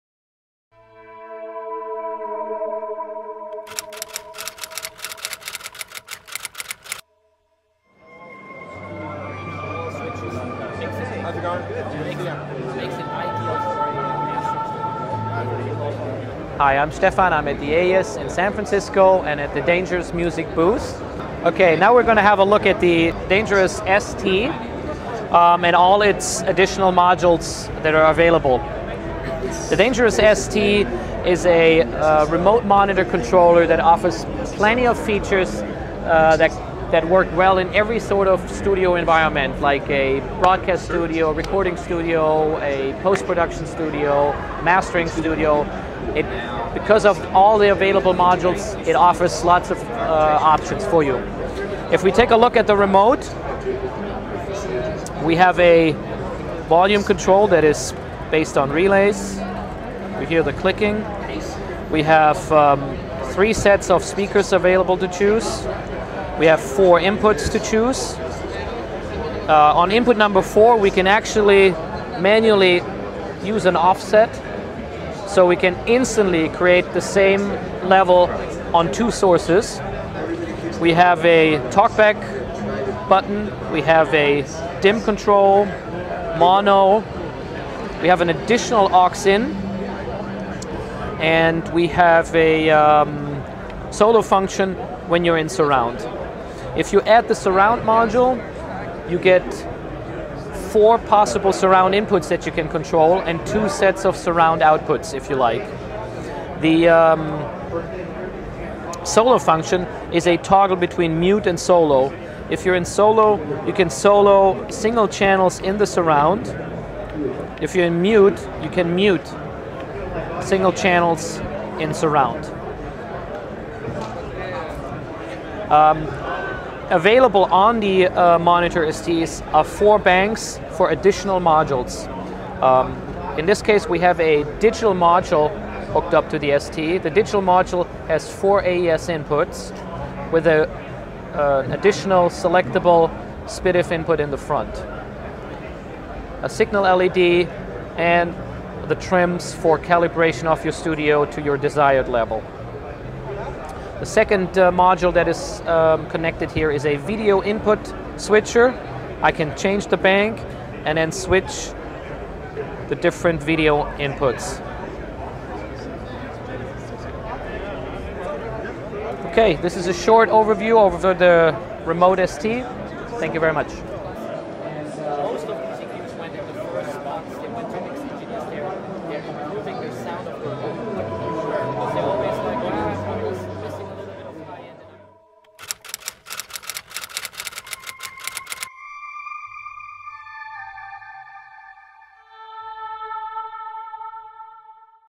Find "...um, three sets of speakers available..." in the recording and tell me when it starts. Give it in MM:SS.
01:02.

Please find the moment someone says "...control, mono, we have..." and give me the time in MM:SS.
01:25.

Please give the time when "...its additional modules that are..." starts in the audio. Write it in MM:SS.
00:26.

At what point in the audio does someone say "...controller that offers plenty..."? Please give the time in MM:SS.
00:33.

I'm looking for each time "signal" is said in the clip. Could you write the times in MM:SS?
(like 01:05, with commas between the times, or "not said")
02:26.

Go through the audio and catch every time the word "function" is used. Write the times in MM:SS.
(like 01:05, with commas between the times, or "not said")
01:34, 01:49.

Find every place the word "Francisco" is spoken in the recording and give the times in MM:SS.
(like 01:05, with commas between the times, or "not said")
00:18.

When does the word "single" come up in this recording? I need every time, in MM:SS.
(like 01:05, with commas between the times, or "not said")
01:54, 02:00.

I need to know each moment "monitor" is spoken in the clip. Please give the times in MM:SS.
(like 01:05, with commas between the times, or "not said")
00:32, 02:08.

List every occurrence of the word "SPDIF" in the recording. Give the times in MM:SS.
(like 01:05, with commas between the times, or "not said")
02:23.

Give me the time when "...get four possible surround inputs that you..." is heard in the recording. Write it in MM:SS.
01:39.